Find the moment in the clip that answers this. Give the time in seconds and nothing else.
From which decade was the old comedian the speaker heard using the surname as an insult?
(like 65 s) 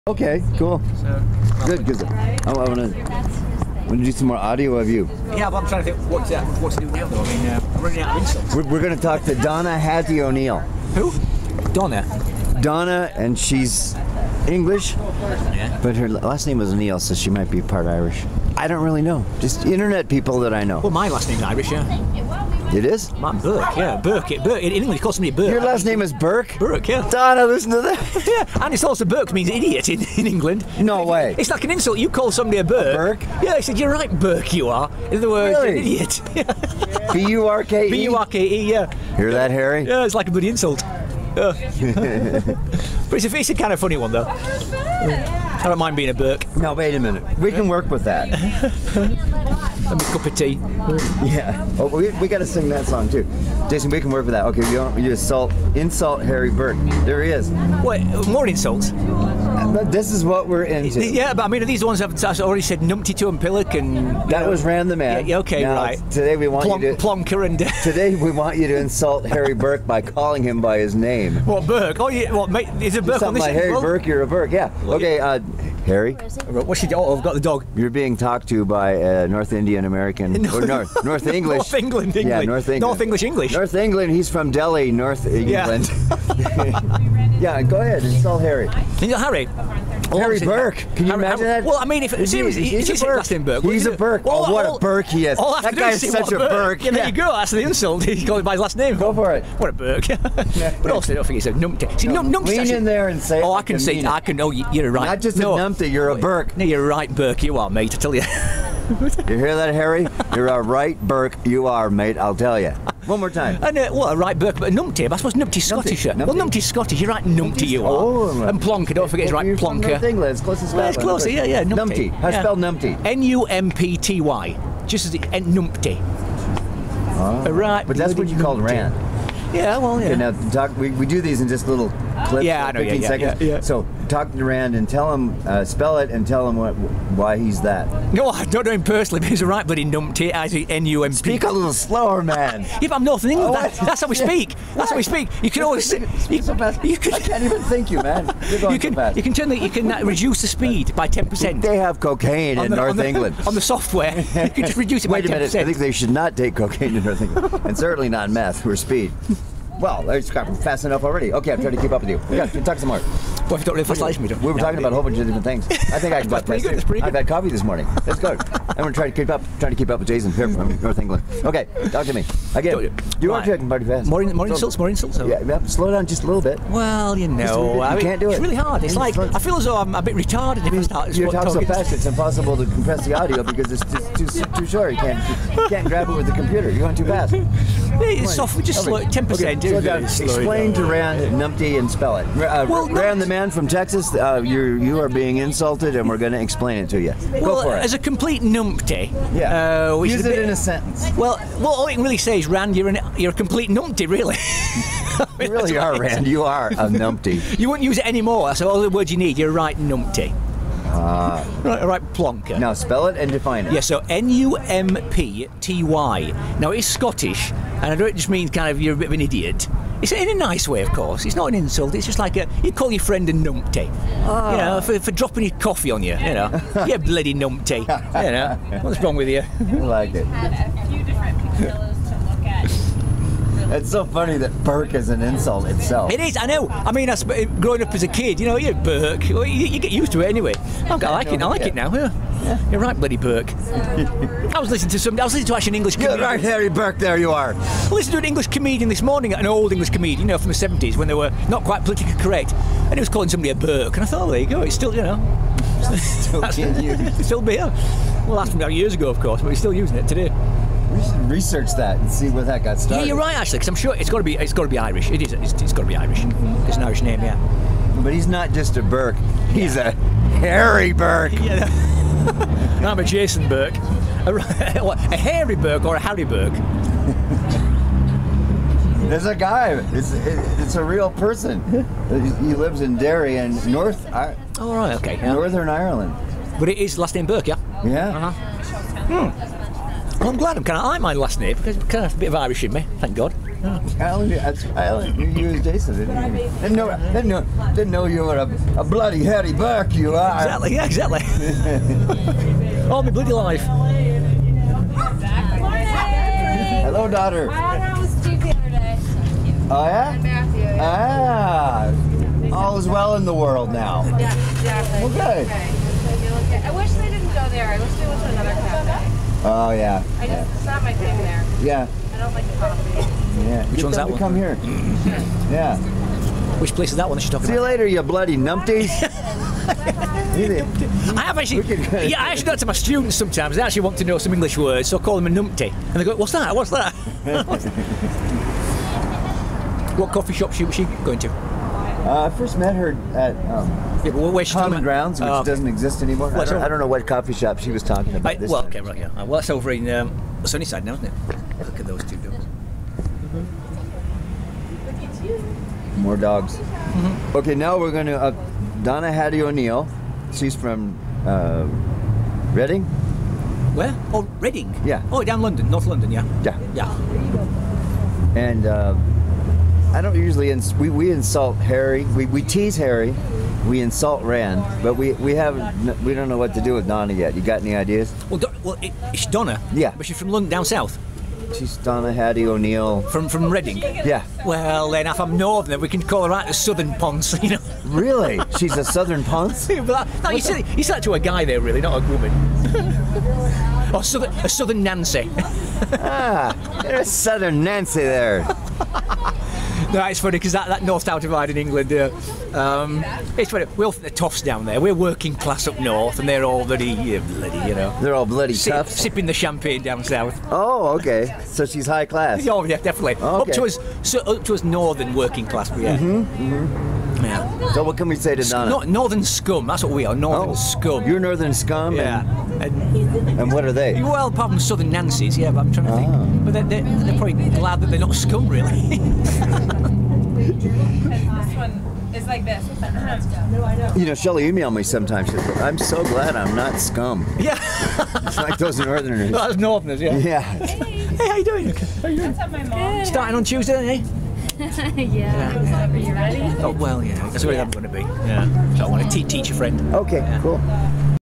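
250 s.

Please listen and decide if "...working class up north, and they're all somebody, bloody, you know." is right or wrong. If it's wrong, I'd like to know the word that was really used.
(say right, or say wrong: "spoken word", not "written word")
wrong: "bloody", not "somebody".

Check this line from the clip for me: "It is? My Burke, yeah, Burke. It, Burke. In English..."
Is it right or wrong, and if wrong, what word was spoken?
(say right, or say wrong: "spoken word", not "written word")
right.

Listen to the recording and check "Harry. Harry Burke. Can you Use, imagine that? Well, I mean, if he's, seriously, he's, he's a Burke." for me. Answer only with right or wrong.
wrong.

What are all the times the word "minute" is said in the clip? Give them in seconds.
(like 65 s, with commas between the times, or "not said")
47 s, 155 s.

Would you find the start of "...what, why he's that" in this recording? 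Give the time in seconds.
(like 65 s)
136 s.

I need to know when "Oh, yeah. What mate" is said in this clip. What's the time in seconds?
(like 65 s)
71 s.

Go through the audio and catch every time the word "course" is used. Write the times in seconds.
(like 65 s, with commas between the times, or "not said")
220 s, 259 s.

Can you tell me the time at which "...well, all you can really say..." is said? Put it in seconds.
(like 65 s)
201 s.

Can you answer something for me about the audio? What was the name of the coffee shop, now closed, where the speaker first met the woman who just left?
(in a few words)
Common Grounds.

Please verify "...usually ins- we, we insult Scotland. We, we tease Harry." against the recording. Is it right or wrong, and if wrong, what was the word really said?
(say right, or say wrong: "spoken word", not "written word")
wrong: "Harry", not "Scotland".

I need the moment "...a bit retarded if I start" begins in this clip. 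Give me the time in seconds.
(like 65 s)
179 s.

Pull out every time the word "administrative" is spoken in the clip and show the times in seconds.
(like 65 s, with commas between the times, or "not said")
not said.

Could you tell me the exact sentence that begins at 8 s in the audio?
We're, we're going to talk to Donna Hattie O'Neill.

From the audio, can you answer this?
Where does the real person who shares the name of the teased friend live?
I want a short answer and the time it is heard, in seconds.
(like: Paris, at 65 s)
Derry, at 282 s.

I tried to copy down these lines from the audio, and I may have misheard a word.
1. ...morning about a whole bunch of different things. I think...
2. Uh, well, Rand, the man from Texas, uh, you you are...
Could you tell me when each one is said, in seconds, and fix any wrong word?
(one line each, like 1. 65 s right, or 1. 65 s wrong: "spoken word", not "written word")
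1. 164 s wrong: "talking", not "morning"
2. 192 s right.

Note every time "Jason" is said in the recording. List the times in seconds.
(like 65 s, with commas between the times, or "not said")
53 s, 170 s, 273 s, 295 s.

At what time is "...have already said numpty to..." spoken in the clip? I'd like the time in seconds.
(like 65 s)
61 s.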